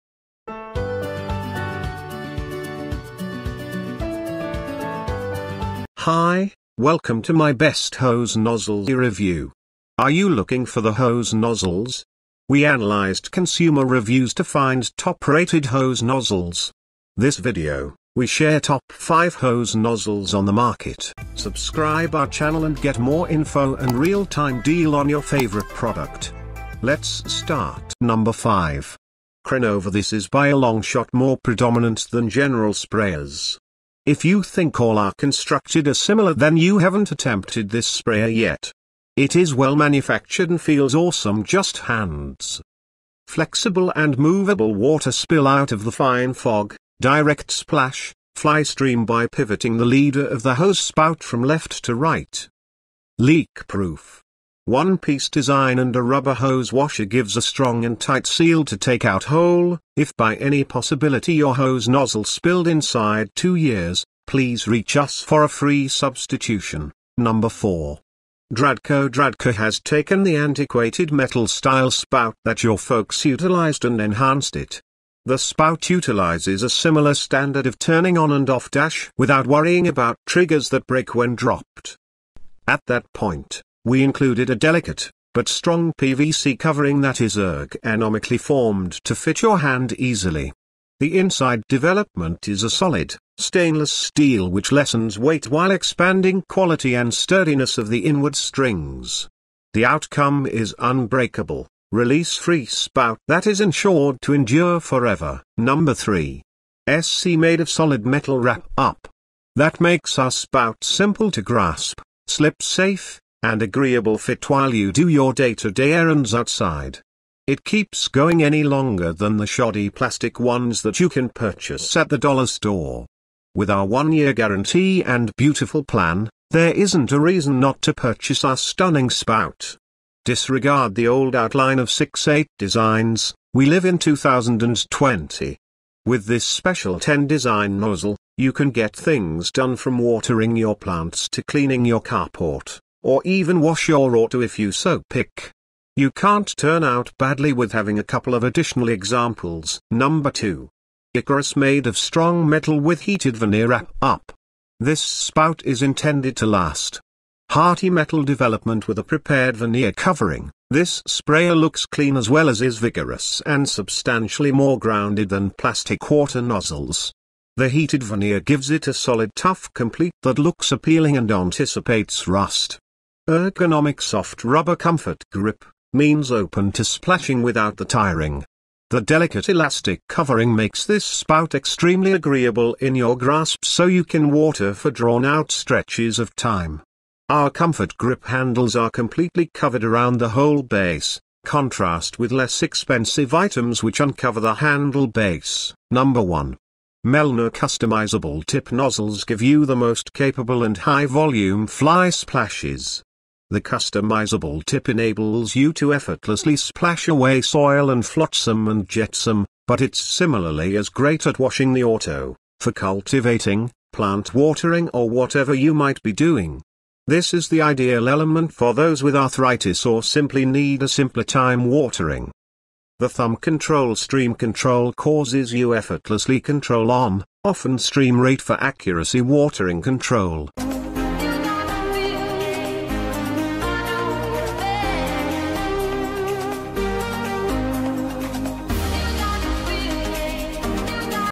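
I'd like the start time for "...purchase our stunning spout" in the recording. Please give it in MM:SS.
02:07.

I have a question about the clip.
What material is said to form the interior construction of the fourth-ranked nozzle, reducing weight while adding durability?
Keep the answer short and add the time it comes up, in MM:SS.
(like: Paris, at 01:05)
stainless steel, at 01:33.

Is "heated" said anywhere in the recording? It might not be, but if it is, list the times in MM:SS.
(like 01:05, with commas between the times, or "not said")
02:33, 02:47.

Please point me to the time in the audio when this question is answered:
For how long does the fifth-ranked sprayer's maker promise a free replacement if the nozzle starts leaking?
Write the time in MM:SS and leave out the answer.
01:03.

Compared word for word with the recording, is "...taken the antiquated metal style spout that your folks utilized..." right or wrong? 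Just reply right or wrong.
right.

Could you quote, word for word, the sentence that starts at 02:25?
You can't turn out badly with having a couple of additional examples.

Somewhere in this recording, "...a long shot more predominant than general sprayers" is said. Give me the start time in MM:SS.
00:30.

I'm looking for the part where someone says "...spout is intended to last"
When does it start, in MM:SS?
02:35.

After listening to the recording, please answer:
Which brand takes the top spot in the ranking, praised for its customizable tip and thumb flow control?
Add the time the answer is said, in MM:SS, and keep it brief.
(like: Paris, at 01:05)
Melnor, at 03:17.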